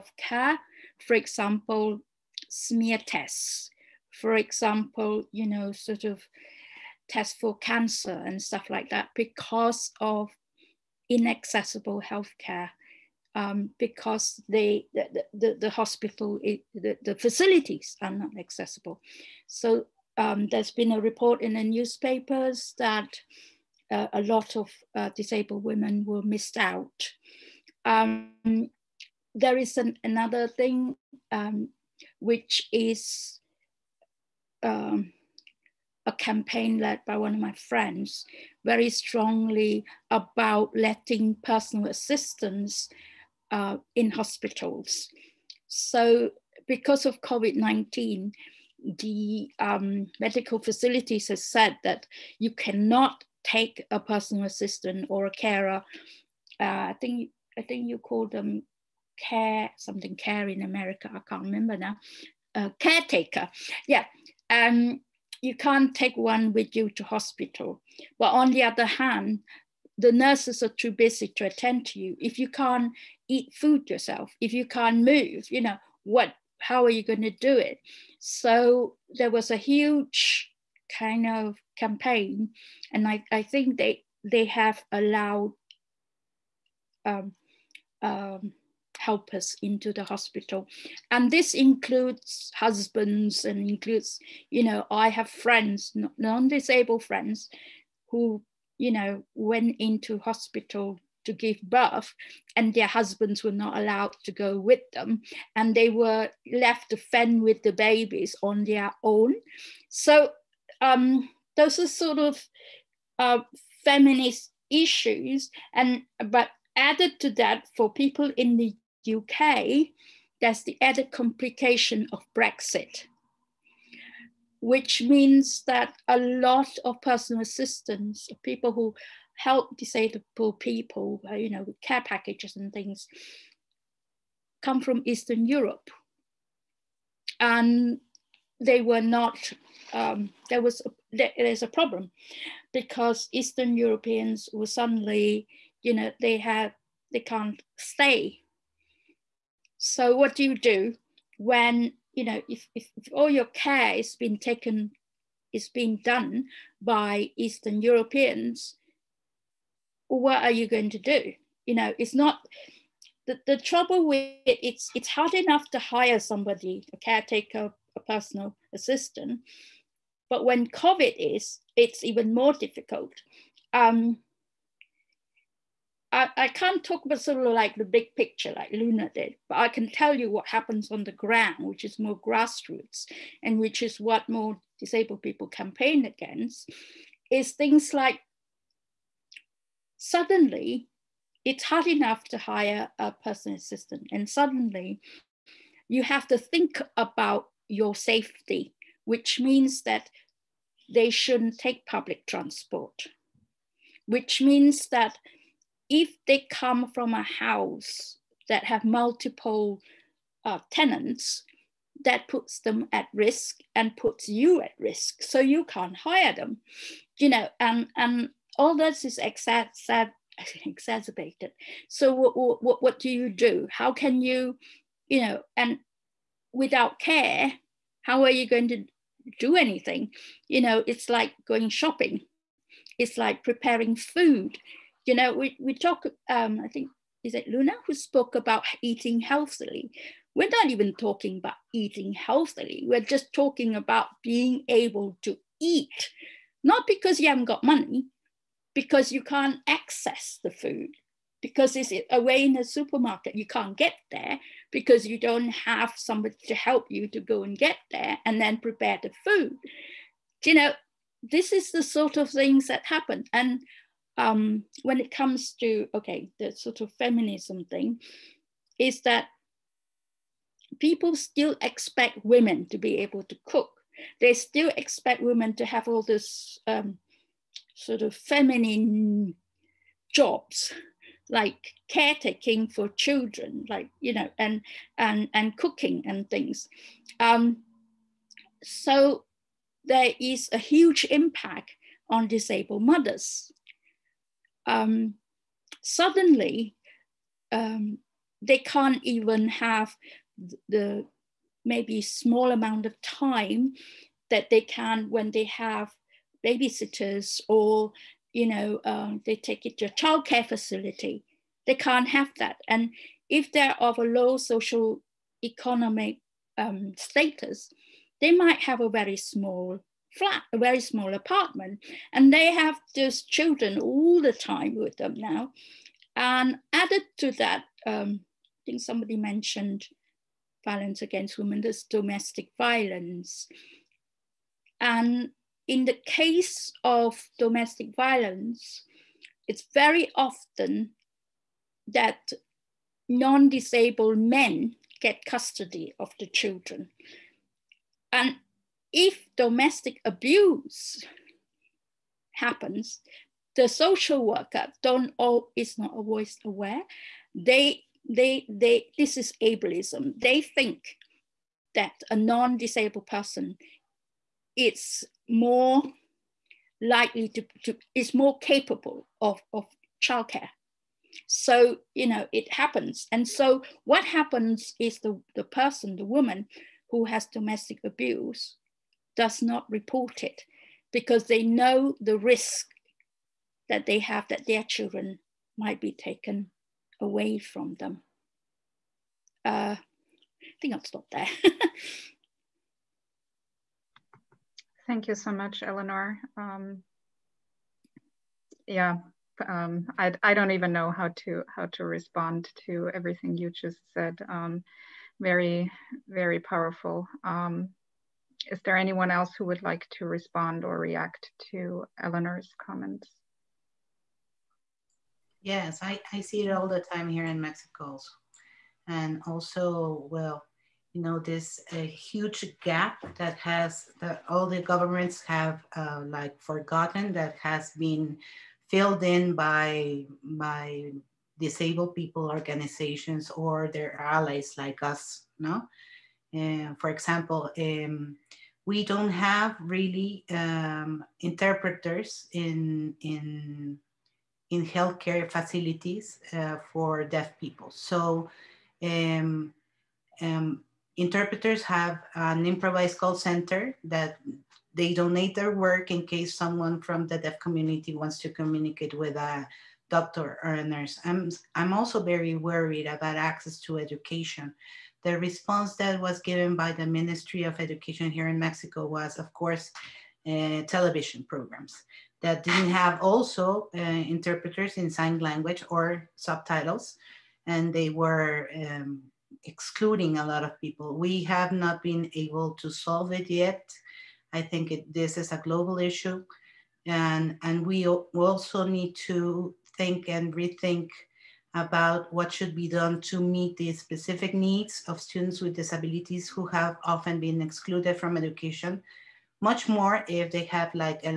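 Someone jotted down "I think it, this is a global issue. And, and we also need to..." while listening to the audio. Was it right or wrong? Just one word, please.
right.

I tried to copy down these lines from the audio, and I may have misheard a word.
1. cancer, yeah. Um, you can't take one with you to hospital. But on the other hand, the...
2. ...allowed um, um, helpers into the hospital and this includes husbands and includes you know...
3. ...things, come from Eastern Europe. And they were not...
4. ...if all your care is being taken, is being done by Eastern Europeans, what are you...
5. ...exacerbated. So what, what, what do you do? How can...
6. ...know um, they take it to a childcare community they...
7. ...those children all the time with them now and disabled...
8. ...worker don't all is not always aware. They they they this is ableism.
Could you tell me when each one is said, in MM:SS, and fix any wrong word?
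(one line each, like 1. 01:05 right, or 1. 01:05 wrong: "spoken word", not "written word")
1. 01:02 wrong: "caretaker", not "cancer"
2. 01:24 right
3. 02:12 right
4. 02:32 right
5. 03:40 right
6. 05:08 wrong: "facility", not "community"
7. 05:22 wrong: "added", not "disabled"
8. 05:54 right.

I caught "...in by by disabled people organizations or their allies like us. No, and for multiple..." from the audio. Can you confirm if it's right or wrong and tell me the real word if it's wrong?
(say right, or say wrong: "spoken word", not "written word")
wrong: "example", not "multiple".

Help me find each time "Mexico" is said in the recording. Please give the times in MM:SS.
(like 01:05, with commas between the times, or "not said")
06:57, 07:48.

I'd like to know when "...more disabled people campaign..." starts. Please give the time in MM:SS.
03:04.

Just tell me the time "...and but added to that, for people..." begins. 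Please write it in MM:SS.
01:55.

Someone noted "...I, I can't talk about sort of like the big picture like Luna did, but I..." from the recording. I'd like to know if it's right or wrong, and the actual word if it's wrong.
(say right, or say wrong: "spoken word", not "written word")
right.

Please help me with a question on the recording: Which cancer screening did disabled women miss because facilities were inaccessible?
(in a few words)
smear tests.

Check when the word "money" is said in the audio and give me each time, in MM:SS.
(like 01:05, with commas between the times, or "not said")
04:07.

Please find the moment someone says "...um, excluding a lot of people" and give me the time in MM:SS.
07:58.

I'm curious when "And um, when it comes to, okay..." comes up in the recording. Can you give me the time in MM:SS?
04:23.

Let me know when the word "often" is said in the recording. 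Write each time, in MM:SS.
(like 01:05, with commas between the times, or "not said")
05:40, 08:16.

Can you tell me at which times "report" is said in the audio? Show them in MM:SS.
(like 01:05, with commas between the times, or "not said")
00:21, 06:19.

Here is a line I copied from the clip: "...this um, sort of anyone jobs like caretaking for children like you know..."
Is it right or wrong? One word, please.
wrong.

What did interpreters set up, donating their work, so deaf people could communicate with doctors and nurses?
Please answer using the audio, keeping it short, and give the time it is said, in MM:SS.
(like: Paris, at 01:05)
an improvised call center, at 07:32.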